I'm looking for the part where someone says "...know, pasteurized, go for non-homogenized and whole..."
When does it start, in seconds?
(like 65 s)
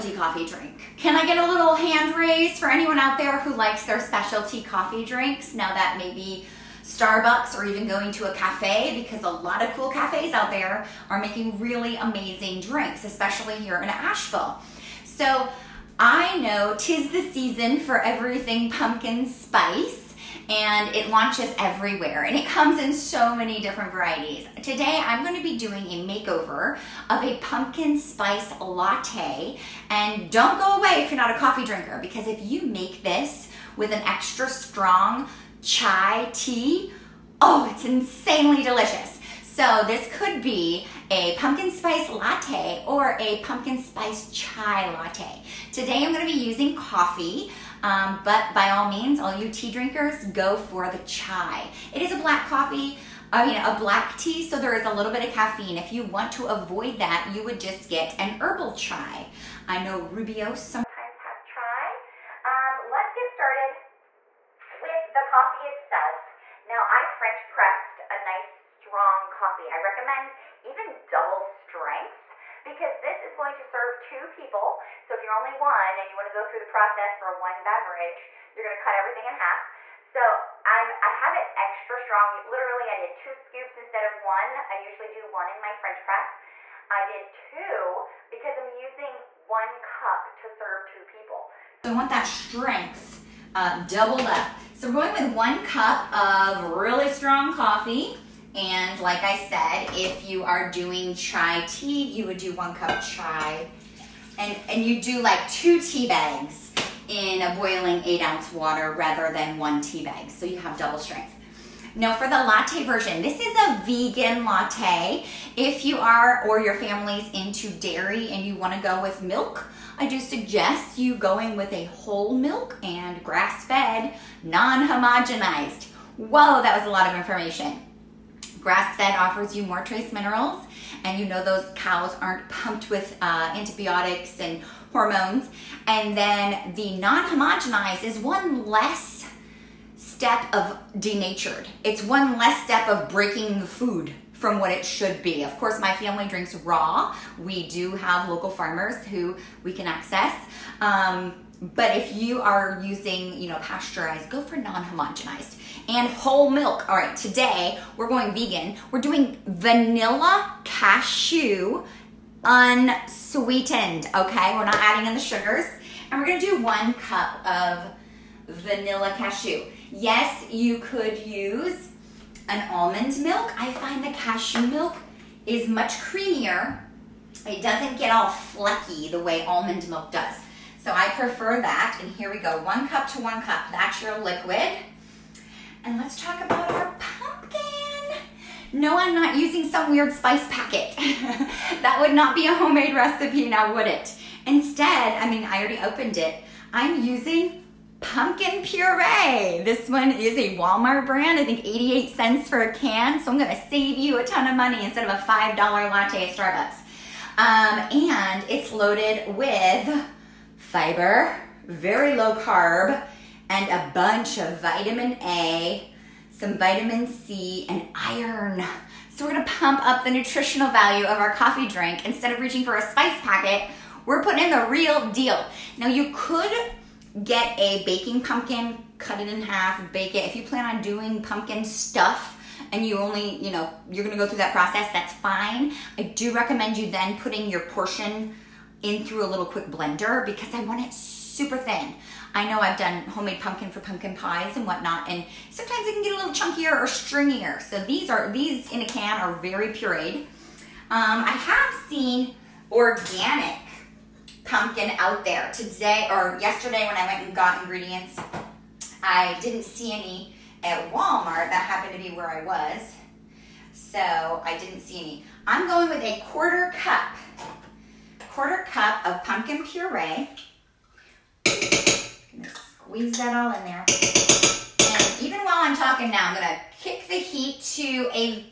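153 s.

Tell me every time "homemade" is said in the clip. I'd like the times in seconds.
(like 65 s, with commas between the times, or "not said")
192 s, 243 s.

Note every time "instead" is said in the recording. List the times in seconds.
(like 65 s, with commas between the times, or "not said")
83 s, 194 s, 204 s, 222 s.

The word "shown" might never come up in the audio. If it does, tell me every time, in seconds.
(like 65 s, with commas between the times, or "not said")
not said.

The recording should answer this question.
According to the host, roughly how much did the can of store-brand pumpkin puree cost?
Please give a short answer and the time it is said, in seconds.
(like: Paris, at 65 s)
88 cents, at 201 s.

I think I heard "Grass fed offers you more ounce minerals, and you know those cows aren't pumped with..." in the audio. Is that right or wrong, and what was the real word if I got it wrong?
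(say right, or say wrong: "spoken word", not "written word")
wrong: "trace", not "ounce".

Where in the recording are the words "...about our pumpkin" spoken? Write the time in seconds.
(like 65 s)
186 s.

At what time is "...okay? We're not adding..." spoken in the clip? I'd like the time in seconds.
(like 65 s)
164 s.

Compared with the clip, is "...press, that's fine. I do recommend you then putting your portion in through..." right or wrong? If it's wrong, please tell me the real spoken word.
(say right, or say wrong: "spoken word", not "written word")
wrong: "process", not "press".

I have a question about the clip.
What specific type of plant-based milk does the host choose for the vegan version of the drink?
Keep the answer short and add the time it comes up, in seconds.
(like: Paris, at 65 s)
vanilla cashew unsweetened, at 159 s.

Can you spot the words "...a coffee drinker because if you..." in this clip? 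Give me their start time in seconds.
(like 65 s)
31 s.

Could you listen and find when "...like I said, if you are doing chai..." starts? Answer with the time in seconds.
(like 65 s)
98 s.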